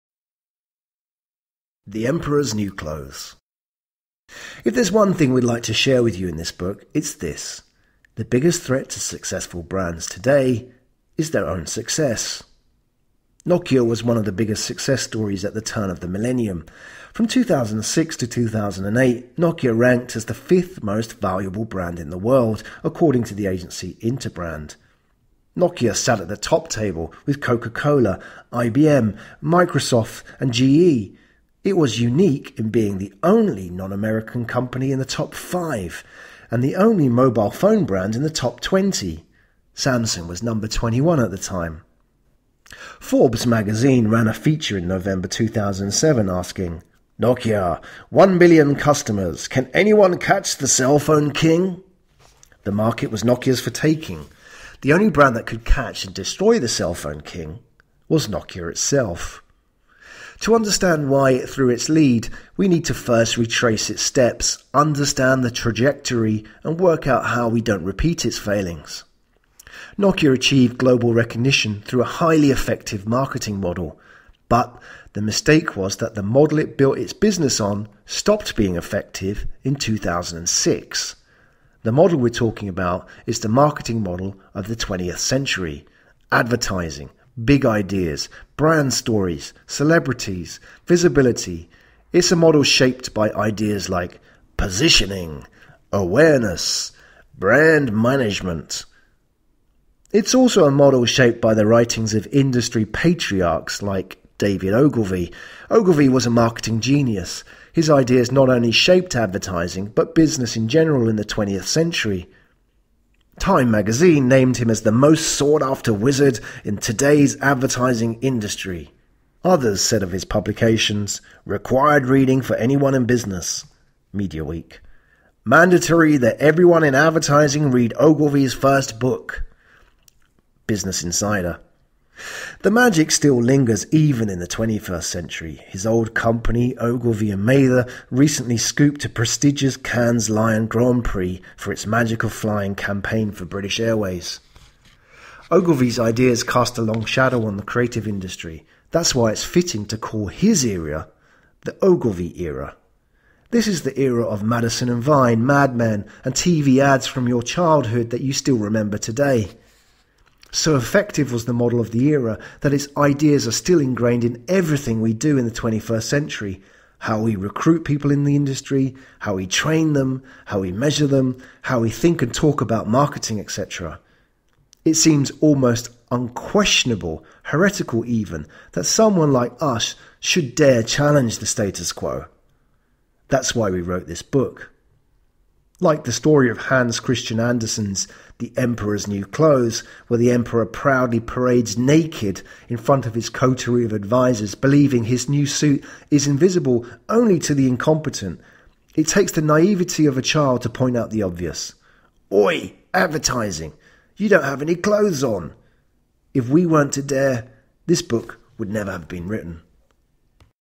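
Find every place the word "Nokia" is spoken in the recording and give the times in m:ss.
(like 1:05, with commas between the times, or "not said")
0:13, 0:19, 0:25, 0:47, 0:53, 0:58, 1:09.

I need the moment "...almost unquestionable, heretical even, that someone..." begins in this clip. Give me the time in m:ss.
2:55.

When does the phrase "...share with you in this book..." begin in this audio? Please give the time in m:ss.
0:05.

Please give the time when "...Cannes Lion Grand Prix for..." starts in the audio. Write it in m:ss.
2:19.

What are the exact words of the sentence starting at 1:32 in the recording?
It's a model shaped by ideas like positioning, awareness, brand management.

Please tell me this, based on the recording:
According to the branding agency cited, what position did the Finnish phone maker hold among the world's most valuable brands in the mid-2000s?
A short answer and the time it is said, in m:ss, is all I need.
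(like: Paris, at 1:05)
fifth, at 0:20.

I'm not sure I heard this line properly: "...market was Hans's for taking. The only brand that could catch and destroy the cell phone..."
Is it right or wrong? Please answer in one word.
wrong.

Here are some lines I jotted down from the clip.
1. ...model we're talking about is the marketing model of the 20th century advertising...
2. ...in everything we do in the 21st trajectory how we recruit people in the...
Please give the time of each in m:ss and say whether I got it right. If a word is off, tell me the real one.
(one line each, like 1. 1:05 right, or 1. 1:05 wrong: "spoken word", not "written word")
1. 1:21 right
2. 2:44 wrong: "century", not "trajectory".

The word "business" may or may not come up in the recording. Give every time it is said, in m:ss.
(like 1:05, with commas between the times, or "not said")
1:17, 1:50, 2:03, 2:10.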